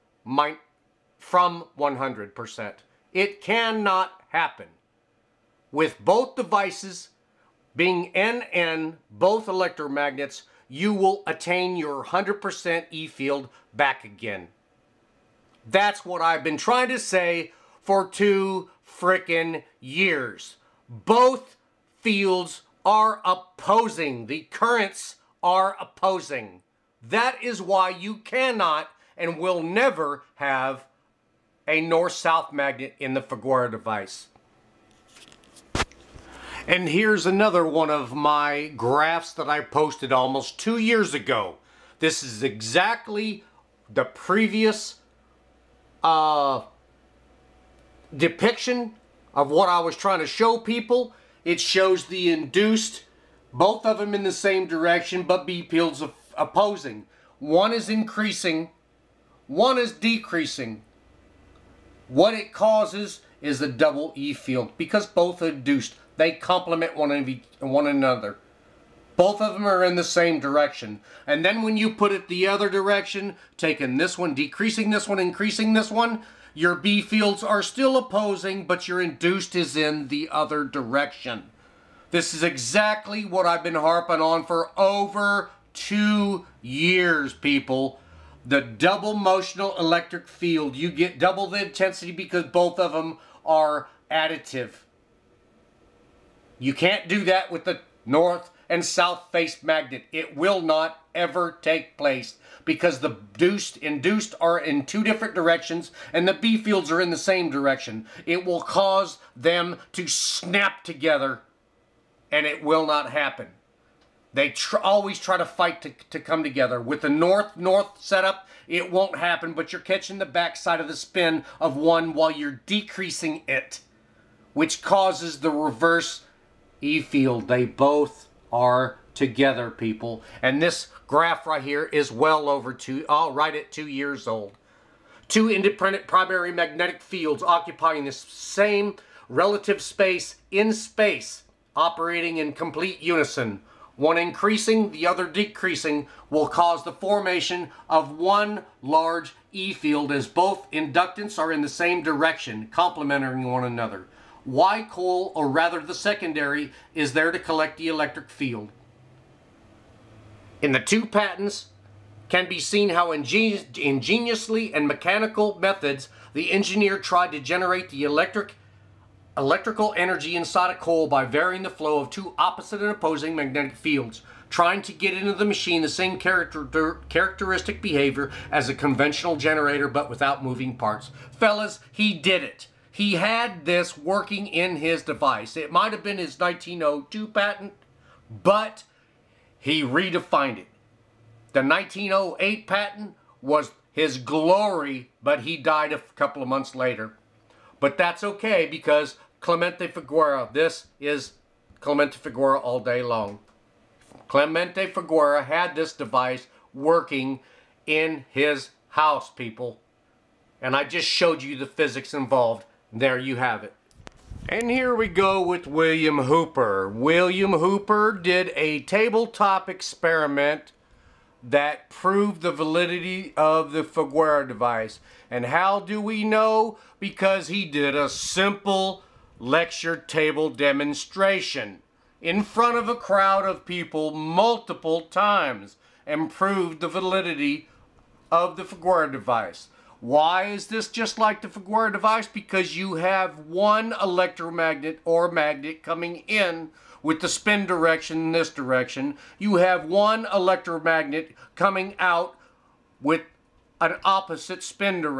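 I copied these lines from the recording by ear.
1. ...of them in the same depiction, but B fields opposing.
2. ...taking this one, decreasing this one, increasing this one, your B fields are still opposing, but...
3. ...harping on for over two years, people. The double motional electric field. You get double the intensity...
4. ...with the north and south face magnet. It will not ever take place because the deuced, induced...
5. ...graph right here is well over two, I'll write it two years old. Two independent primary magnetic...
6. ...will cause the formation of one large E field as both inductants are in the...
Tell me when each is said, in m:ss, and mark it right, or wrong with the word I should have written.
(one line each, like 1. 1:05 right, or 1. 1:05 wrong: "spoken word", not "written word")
1. 0:53 wrong: "direction", not "depiction"
2. 1:13 right
3. 1:23 right
4. 1:37 right
5. 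2:11 right
6. 2:26 right.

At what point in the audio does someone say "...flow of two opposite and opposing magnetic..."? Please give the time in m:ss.
2:51.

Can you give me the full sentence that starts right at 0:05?
With both devices being NN, both electromagnets, you will attain your 100% E field back again.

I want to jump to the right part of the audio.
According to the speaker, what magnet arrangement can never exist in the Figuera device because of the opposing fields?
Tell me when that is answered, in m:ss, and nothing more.
0:31.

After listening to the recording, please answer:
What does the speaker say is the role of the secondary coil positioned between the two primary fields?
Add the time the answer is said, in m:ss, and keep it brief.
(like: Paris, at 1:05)
to collect the electric field, at 2:37.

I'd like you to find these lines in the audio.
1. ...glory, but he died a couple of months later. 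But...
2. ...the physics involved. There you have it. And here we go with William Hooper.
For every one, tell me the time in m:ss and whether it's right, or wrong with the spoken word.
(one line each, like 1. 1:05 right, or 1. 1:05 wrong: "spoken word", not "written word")
1. 3:14 right
2. 3:31 right.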